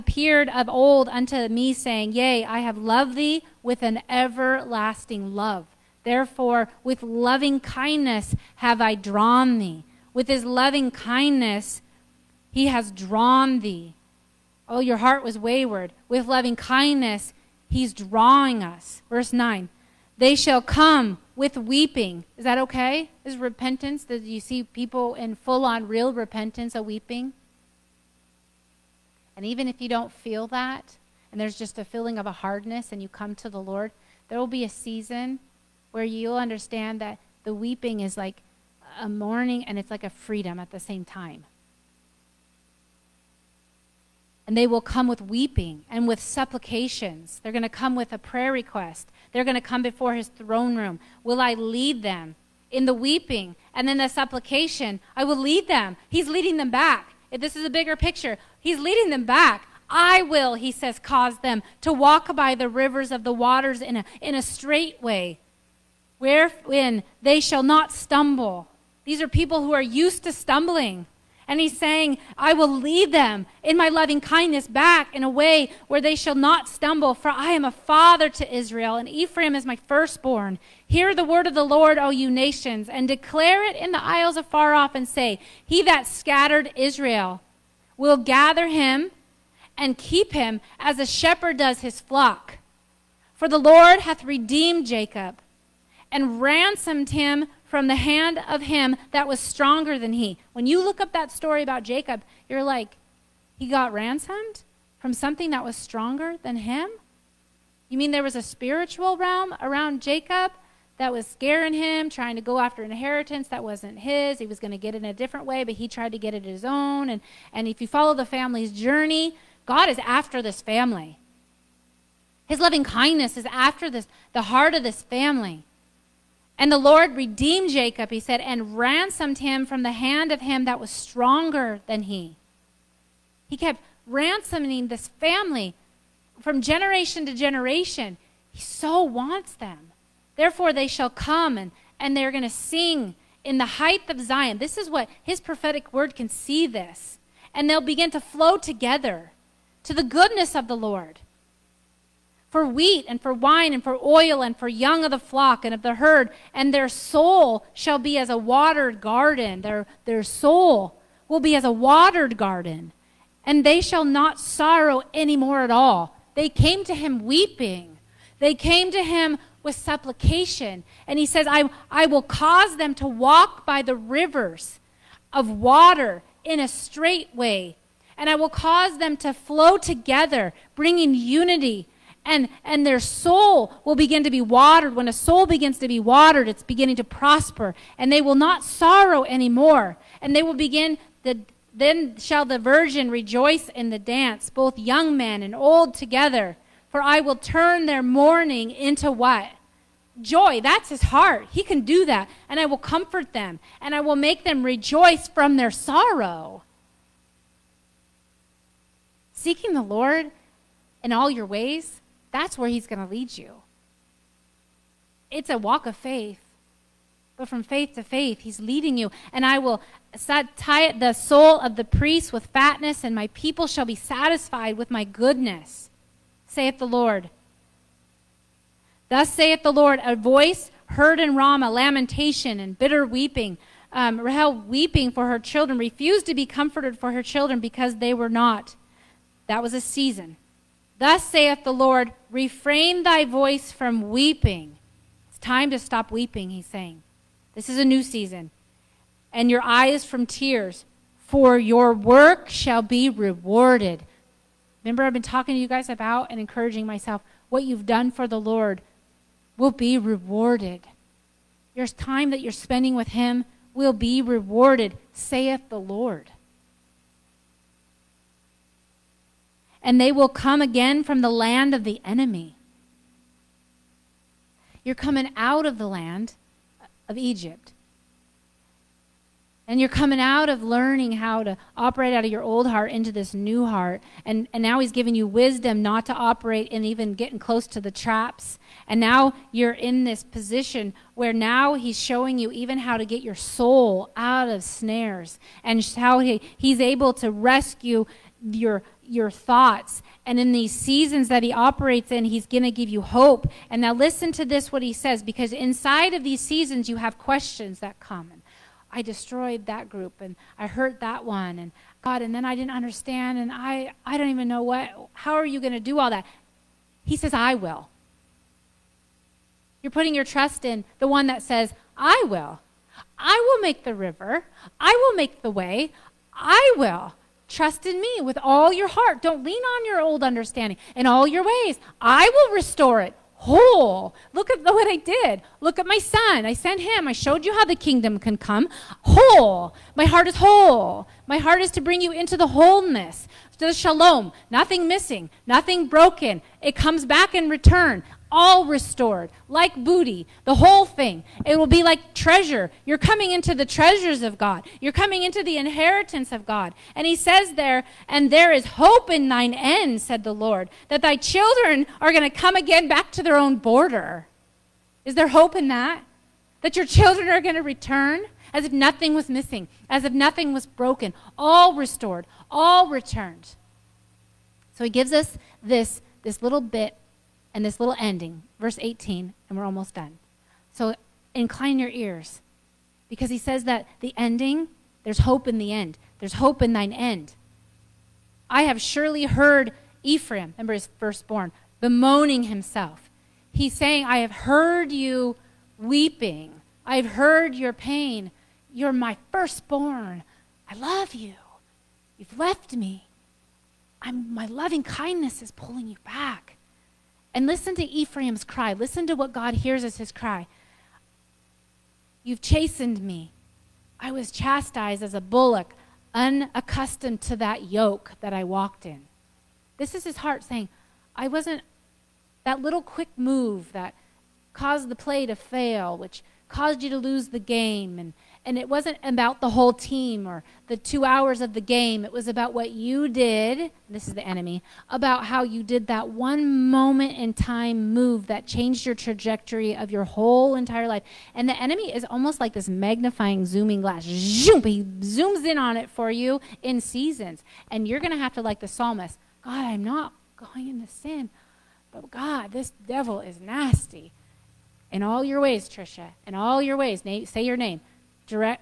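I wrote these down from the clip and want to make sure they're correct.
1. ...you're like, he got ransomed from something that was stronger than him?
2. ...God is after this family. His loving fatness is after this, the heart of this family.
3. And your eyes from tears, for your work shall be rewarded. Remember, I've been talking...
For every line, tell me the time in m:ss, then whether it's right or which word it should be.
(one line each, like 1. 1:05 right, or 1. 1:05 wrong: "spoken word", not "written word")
1. 1:42 right
2. 1:59 wrong: "kindness", not "fatness"
3. 4:09 right.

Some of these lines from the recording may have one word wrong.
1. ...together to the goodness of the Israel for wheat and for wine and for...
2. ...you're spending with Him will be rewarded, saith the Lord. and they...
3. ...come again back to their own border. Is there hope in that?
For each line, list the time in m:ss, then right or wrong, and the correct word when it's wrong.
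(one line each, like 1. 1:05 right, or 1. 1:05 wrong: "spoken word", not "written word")
1. 2:28 wrong: "Lord", not "Israel"
2. 4:22 right
3. 6:02 right.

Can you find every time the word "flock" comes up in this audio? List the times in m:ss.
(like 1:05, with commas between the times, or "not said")
1:31, 2:35.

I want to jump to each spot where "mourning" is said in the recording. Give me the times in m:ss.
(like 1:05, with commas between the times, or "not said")
0:39, 3:18.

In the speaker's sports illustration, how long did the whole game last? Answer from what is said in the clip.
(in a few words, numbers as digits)
2 hours.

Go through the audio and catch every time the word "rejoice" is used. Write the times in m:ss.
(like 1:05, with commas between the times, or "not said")
3:13, 3:24.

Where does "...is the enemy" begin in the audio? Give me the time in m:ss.
7:14.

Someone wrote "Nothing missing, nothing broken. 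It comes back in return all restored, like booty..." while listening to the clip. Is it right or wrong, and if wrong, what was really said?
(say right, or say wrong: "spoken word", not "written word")
right.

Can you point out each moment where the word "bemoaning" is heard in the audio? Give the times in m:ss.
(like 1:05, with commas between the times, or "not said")
6:31.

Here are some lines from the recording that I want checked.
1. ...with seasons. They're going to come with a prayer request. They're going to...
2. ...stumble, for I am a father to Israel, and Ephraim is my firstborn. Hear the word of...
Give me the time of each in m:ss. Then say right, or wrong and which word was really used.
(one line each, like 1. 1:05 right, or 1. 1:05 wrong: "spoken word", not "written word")
1. 0:46 wrong: "supplications", not "seasons"
2. 1:16 right.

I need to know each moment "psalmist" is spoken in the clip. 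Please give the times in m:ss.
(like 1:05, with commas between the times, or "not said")
7:28.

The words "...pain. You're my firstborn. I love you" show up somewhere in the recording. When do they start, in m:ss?
6:37.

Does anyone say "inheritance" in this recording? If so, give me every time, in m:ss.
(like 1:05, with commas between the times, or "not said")
1:52, 5:55.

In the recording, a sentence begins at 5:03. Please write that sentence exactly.
And now listen to this, what he says, because inside of these seasons, you have questions that come.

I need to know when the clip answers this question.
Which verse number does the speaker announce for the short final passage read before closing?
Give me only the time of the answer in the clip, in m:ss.
6:18.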